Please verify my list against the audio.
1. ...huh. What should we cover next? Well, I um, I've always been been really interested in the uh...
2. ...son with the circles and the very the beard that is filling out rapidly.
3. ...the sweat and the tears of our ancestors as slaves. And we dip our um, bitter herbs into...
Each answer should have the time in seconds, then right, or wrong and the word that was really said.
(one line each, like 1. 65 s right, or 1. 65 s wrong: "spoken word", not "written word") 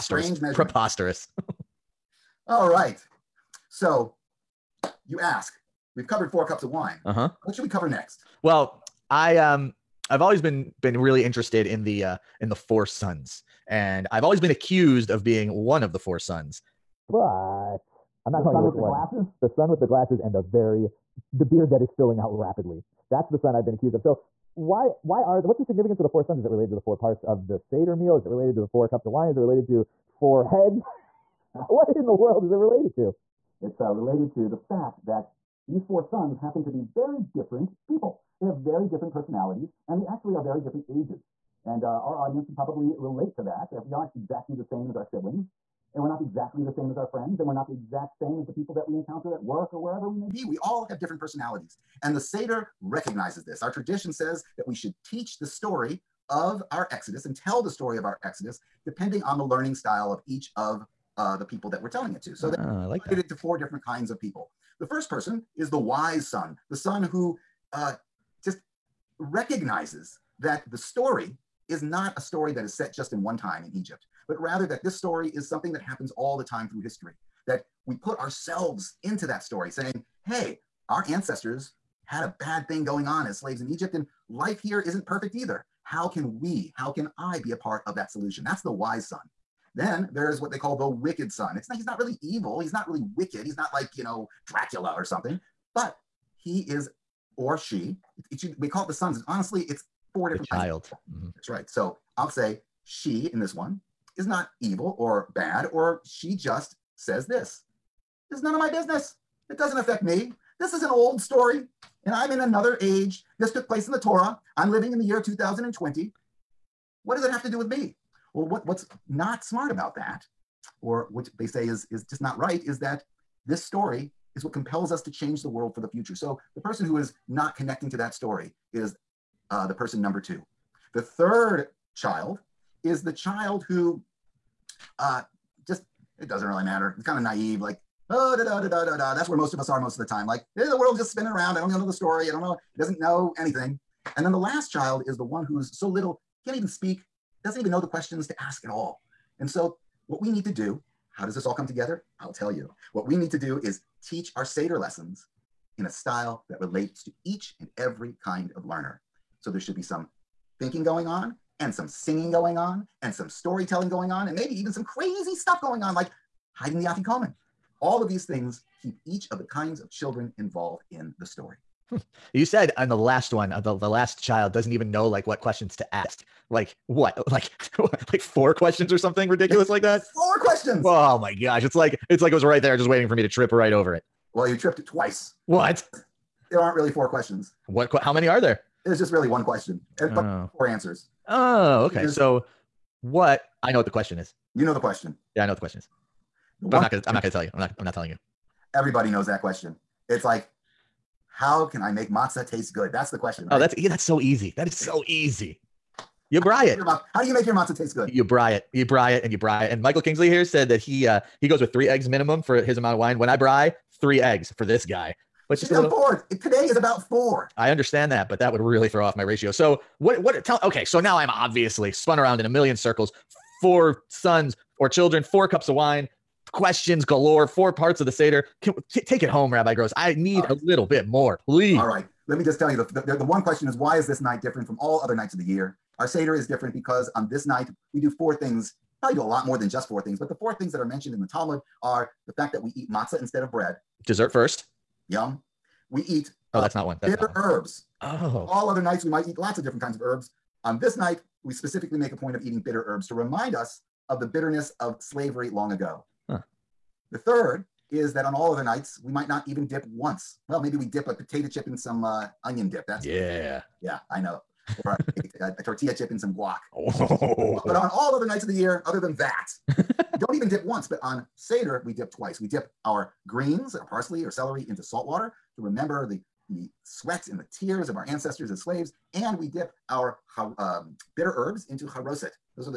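1. 7 s right
2. 19 s wrong: "glasses", not "circles"
3. 276 s right.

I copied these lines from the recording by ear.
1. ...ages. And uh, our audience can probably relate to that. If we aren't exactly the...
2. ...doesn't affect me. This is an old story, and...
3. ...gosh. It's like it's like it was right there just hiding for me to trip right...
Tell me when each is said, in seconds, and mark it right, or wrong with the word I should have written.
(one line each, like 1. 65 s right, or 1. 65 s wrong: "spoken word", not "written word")
1. 40 s right
2. 109 s right
3. 181 s wrong: "waiting", not "hiding".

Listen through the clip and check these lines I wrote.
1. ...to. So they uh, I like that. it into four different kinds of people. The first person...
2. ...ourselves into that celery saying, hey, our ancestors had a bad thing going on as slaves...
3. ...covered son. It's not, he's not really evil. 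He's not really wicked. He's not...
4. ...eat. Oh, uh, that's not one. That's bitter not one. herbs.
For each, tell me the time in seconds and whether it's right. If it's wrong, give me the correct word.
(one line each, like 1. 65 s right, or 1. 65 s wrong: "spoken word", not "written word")
1. 62 s right
2. 78 s wrong: "story", not "celery"
3. 90 s wrong: "wicked", not "covered"
4. 246 s right.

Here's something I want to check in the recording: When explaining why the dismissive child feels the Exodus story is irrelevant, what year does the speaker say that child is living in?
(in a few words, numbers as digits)
2020.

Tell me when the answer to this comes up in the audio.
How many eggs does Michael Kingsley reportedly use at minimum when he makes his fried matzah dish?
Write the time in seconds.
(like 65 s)
211 s.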